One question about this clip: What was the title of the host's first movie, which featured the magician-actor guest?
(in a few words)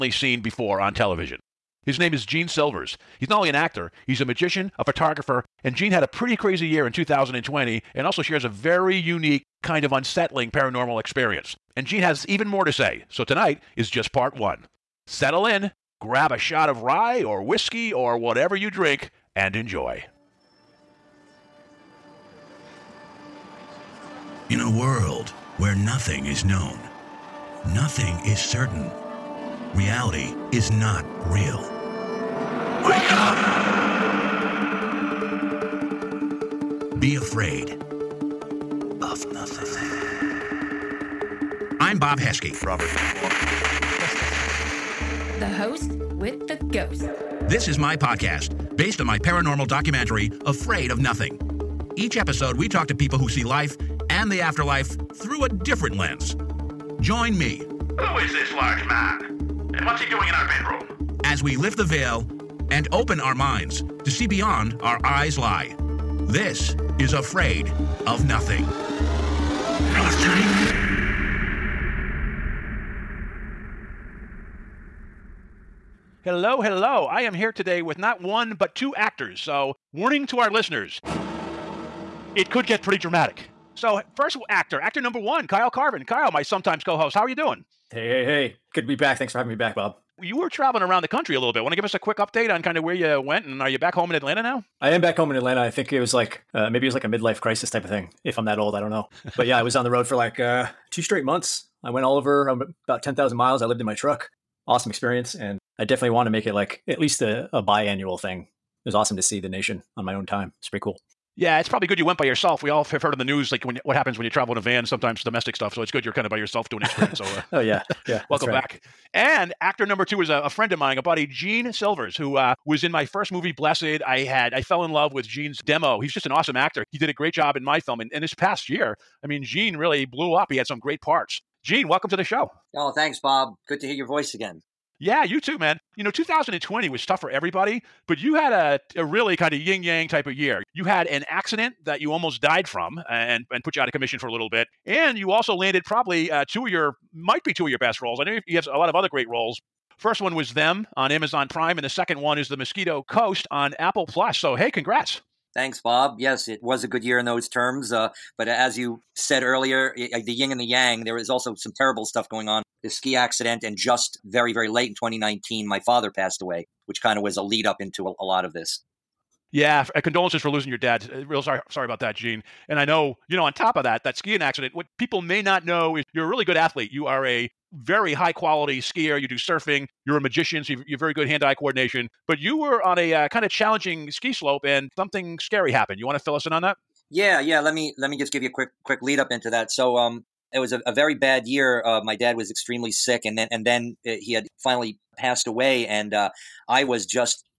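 Blessed.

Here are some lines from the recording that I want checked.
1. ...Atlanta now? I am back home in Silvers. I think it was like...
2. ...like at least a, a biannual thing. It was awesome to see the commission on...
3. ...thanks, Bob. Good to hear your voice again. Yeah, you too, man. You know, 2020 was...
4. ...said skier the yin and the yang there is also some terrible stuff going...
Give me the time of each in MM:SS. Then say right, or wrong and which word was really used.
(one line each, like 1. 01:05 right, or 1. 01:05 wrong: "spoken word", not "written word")
1. 01:34 wrong: "Atlanta", not "Silvers"
2. 01:46 wrong: "nation", not "commission"
3. 02:12 right
4. 02:39 wrong: "earlier", not "skier".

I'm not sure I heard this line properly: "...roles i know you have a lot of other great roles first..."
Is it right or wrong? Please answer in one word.
right.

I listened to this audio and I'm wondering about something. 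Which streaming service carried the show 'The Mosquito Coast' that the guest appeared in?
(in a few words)
Apple Plus.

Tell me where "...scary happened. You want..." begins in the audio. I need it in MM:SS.
03:05.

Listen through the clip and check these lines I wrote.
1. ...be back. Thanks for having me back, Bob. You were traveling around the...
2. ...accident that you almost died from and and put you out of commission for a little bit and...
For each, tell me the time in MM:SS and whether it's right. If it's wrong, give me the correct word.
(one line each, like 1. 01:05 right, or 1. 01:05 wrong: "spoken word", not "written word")
1. 01:28 right
2. 02:21 right.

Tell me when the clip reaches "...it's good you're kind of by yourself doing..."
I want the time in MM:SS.
01:55.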